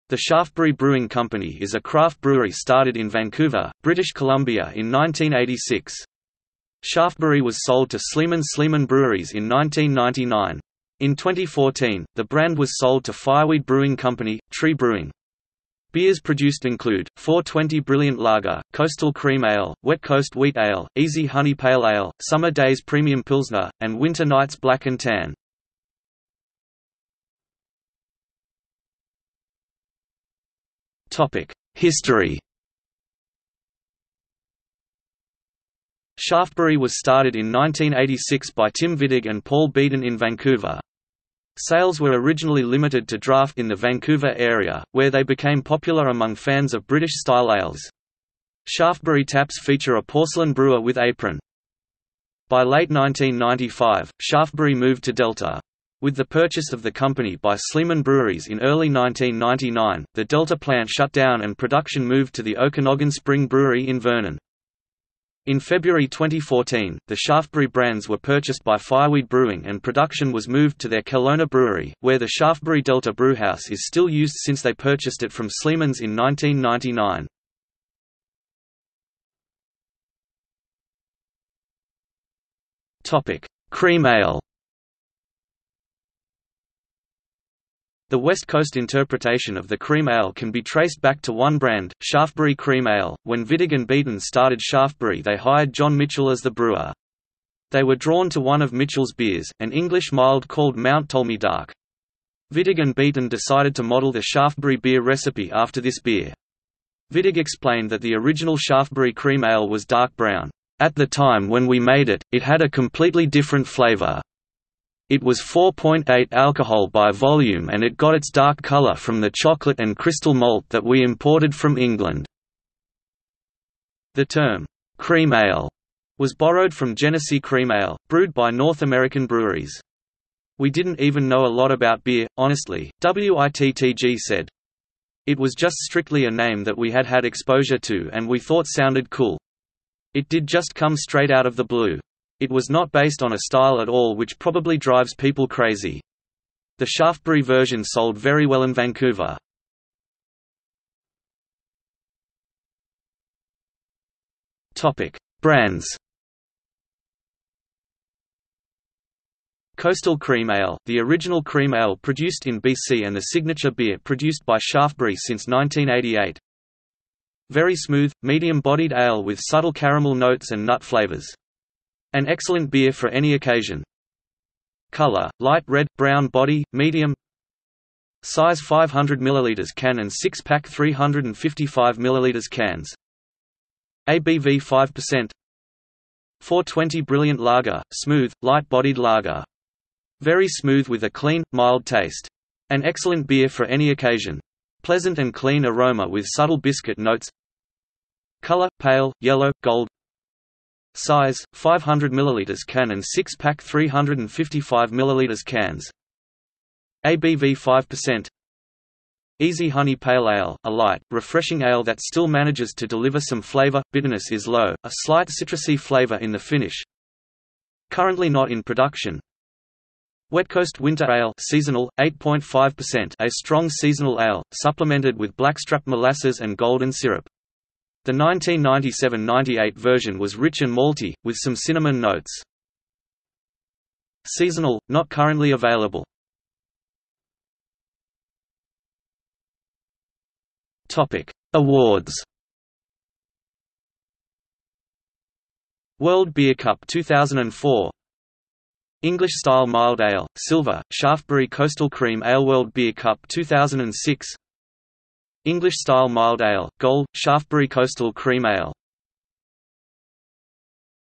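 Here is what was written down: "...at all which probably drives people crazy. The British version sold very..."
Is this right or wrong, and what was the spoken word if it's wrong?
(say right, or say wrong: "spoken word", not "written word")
wrong: "Shaftebury", not "British".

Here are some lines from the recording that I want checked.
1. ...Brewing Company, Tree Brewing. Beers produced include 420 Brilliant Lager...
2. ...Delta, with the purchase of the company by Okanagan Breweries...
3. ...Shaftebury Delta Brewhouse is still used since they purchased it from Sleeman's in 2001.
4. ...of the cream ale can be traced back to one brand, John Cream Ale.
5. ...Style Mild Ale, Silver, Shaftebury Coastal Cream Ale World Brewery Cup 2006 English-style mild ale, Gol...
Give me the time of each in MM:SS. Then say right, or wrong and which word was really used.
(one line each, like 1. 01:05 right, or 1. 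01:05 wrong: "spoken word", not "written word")
1. 00:13 right
2. 00:55 wrong: "Sleeman", not "Okanagan"
3. 01:12 wrong: "1999", not "2001"
4. 01:29 wrong: "Shaftebury", not "John"
5. 04:09 wrong: "Beer", not "Brewery".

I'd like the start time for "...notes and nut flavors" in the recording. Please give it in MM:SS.
02:50.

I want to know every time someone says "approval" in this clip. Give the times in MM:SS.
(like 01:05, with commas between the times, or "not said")
not said.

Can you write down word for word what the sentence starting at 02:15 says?
It was just strictly a name that we had had exposure to and we thought sounded cool.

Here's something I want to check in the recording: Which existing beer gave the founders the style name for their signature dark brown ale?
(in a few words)
Genesee cream ale.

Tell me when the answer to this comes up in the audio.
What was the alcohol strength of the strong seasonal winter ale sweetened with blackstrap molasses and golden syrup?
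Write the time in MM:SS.
03:42.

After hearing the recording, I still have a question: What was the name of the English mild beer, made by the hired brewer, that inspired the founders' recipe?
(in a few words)
Mount Ptolemy Dark.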